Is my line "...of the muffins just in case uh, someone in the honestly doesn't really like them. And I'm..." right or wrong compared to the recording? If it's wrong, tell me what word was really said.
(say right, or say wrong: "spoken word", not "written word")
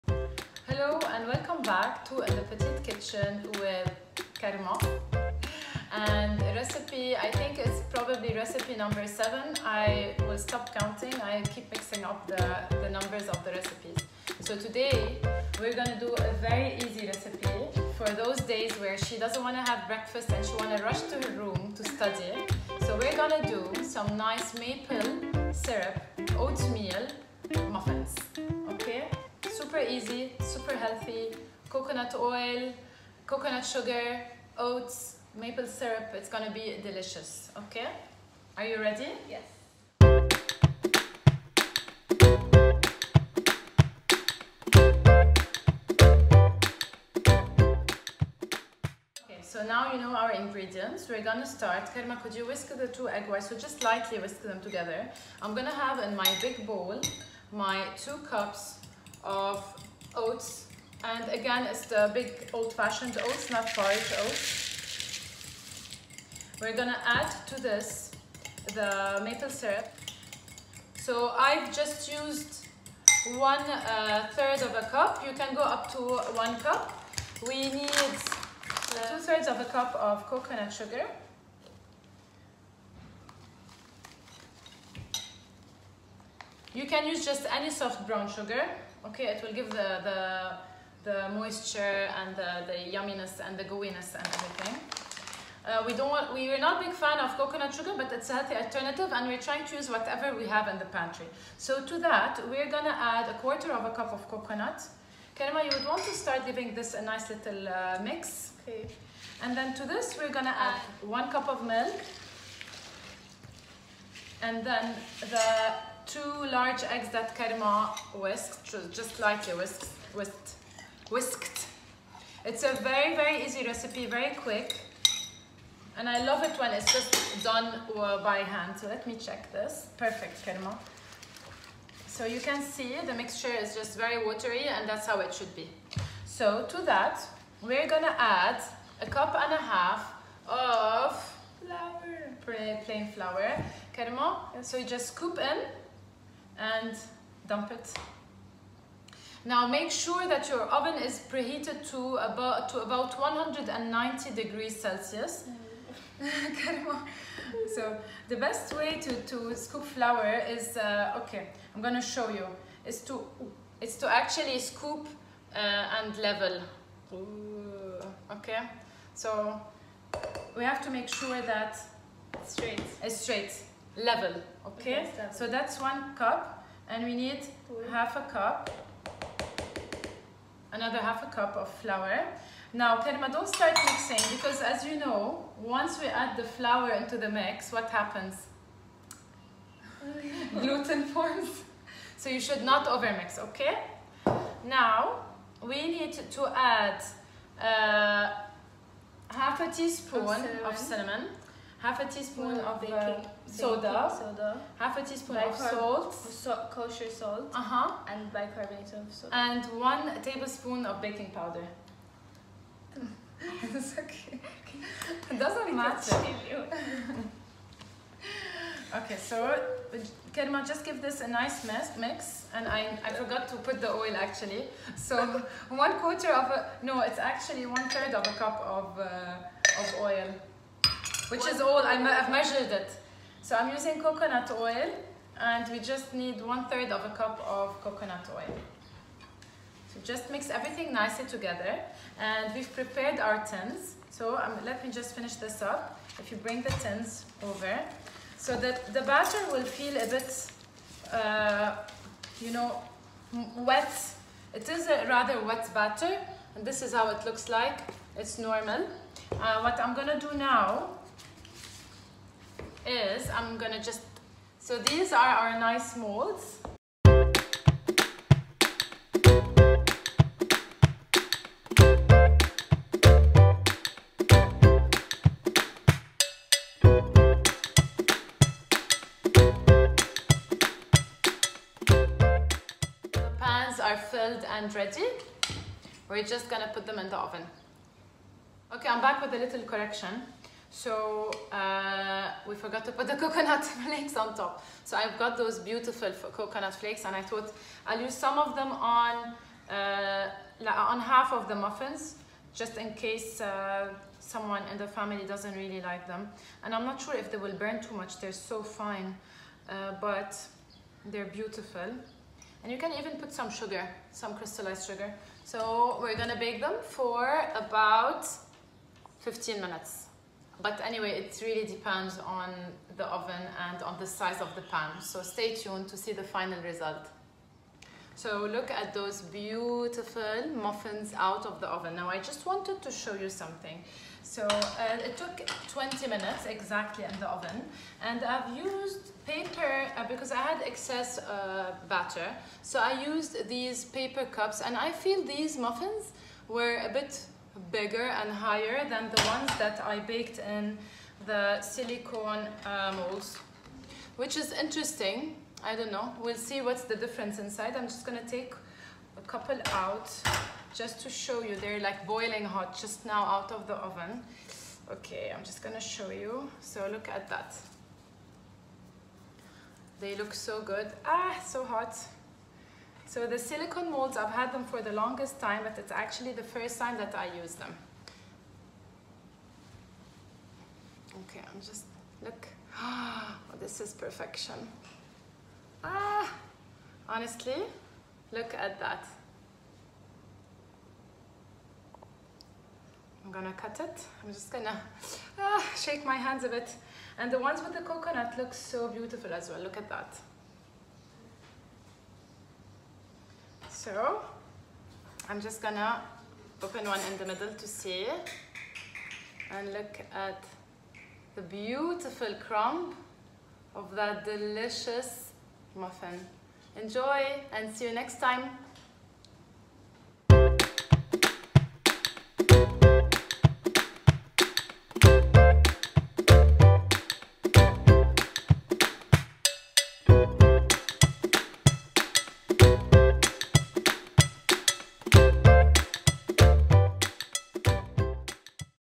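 wrong: "family", not "honestly".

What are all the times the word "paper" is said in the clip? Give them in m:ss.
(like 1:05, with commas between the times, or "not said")
5:39, 5:43.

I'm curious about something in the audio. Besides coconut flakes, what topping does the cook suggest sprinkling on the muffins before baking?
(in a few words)
crystallized sugar.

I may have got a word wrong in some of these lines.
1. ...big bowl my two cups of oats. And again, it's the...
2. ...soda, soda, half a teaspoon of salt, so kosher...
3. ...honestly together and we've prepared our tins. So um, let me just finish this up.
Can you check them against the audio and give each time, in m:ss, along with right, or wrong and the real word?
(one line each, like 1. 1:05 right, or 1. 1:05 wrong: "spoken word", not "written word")
1. 0:56 right
2. 3:23 right
3. 4:00 wrong: "nicely", not "honestly".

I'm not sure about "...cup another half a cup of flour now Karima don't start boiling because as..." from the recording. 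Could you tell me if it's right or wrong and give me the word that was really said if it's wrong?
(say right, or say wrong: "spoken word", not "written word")
wrong: "mixing", not "boiling".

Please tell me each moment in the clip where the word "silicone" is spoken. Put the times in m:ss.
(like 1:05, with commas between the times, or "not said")
5:51, 6:13.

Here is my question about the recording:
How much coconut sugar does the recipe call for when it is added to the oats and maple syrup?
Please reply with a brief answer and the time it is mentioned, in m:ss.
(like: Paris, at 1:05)
2/3 cup, at 1:18.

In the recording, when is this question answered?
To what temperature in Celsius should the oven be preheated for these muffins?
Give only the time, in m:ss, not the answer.
2:33.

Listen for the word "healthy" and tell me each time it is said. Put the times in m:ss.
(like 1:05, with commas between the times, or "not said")
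0:30, 1:38.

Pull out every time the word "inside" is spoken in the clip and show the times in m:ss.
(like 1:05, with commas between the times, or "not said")
5:57.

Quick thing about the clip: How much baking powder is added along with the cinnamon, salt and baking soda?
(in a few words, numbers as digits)
1 tablespoon.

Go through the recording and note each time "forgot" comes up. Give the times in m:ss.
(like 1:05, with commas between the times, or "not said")
3:43, 4:52.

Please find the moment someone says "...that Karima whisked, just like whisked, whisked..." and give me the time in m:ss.
1:57.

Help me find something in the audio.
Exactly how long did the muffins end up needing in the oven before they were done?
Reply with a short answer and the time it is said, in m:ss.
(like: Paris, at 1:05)
20 minutes, at 5:35.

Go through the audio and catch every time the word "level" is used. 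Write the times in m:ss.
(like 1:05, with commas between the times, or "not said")
2:46, 2:53.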